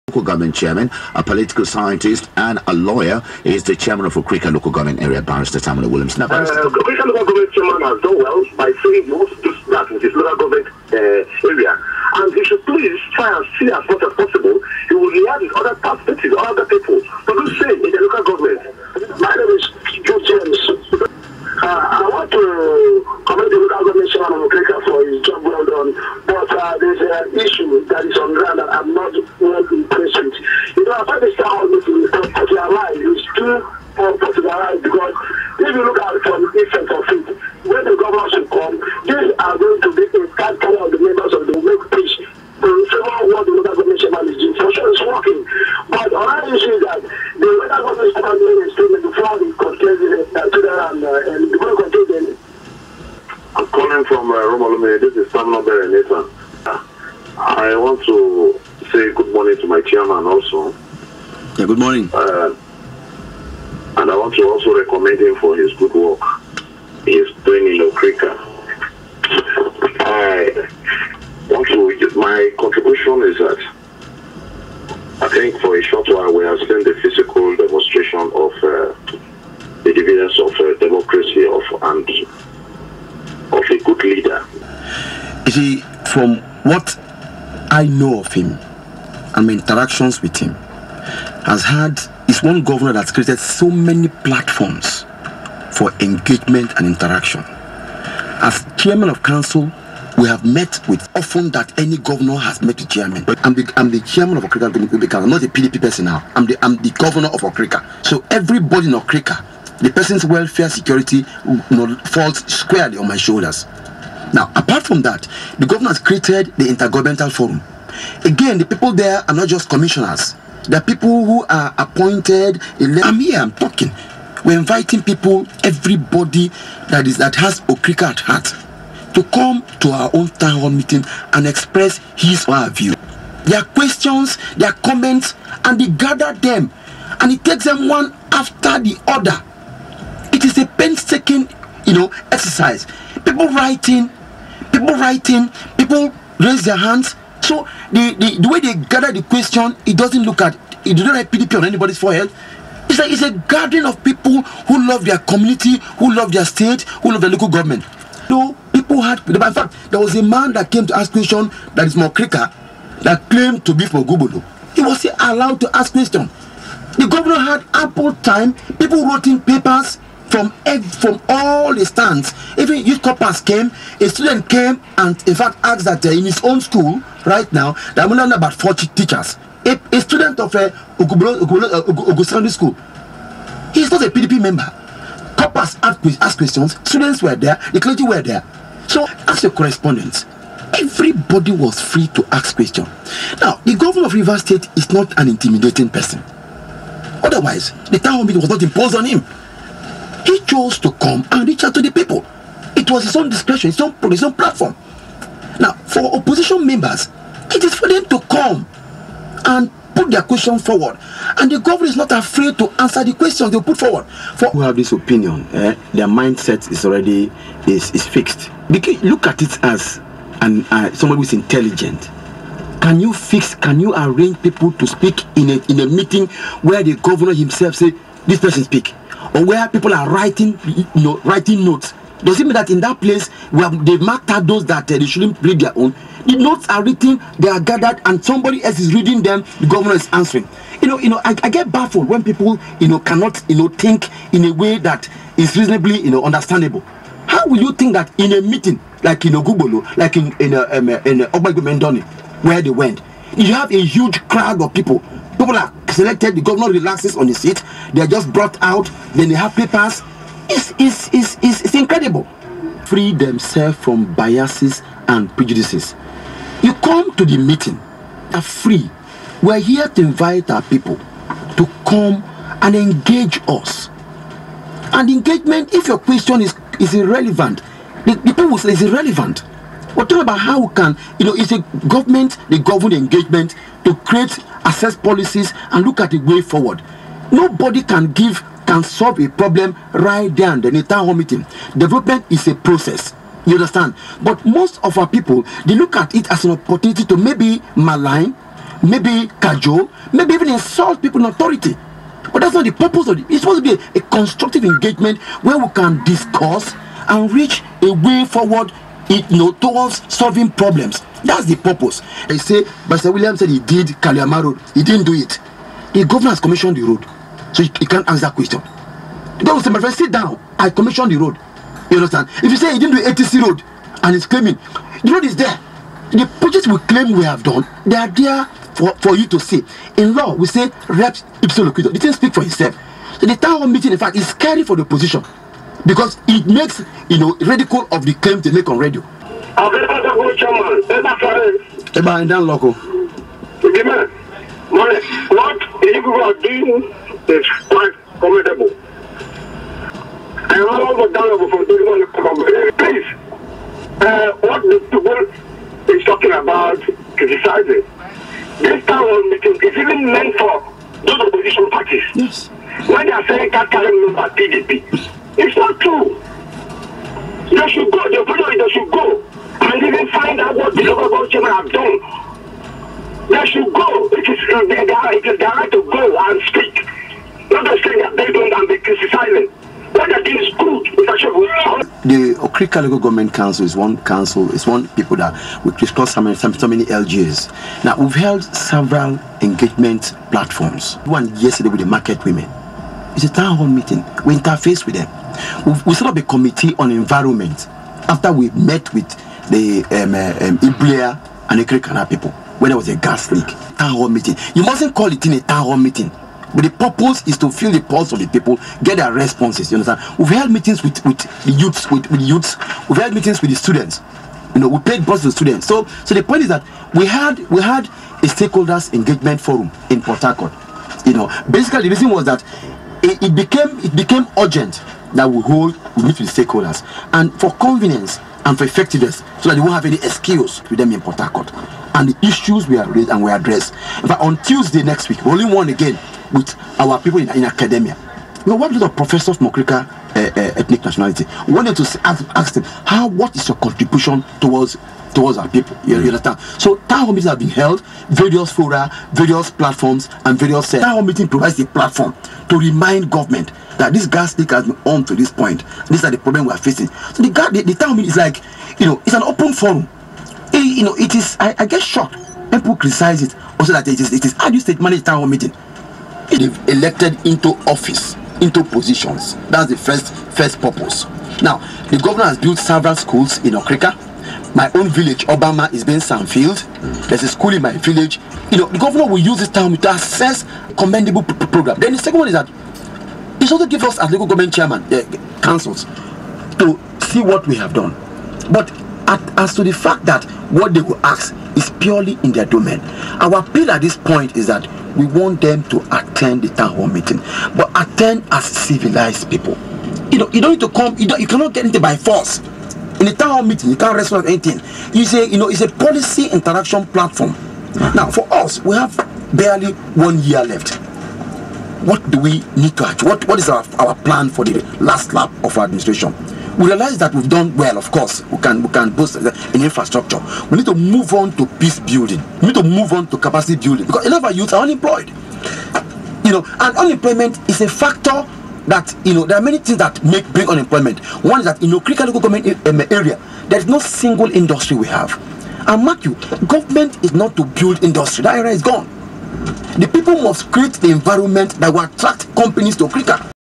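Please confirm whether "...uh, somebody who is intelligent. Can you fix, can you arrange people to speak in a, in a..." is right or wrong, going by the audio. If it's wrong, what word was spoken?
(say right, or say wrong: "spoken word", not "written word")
right.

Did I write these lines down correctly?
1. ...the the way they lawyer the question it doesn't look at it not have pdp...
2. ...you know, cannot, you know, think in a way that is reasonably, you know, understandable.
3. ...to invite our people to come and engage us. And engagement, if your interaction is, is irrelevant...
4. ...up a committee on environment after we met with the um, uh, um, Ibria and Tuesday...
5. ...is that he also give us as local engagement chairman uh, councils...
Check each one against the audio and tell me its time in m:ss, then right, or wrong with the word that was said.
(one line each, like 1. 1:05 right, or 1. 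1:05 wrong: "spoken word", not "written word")
1. 2:28 wrong: "gather", not "lawyer"
2. 4:02 right
3. 4:29 wrong: "question", not "interaction"
4. 6:36 wrong: "Okrika", not "Tuesday"
5. 8:02 wrong: "government", not "engagement".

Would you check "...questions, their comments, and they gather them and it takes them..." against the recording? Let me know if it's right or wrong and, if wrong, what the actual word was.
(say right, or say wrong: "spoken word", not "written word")
right.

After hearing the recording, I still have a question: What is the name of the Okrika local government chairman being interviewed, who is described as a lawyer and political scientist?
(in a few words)
Tamuno Williams.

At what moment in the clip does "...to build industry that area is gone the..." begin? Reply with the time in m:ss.
8:57.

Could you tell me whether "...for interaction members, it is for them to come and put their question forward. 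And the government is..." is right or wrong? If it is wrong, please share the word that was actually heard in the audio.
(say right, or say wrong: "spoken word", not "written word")
wrong: "opposition", not "interaction".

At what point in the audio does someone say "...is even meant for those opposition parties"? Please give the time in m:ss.
5:59.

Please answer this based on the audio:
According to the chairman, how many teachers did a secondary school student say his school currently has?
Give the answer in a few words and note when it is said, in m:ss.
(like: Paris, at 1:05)
40, at 2:58.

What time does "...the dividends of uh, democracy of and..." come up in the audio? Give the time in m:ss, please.
1:19.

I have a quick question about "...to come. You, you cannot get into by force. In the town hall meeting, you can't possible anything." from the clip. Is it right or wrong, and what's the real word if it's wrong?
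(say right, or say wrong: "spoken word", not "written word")
wrong: "wrestle", not "possible".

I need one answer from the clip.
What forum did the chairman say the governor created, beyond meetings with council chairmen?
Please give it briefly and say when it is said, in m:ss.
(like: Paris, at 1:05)
Intergovernmental Forum, at 1:56.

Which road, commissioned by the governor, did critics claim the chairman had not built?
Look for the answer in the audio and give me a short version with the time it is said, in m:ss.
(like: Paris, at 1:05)
Kaliama Road, at 5:13.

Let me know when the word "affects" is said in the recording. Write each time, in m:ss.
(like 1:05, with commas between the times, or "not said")
not said.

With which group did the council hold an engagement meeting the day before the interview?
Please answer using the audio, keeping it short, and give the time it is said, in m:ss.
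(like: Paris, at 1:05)
market women, at 6:31.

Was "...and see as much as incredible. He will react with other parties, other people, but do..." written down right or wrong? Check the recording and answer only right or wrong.
wrong.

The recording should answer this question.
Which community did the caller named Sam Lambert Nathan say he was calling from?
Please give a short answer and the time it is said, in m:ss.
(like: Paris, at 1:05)
Romalumi, at 0:54.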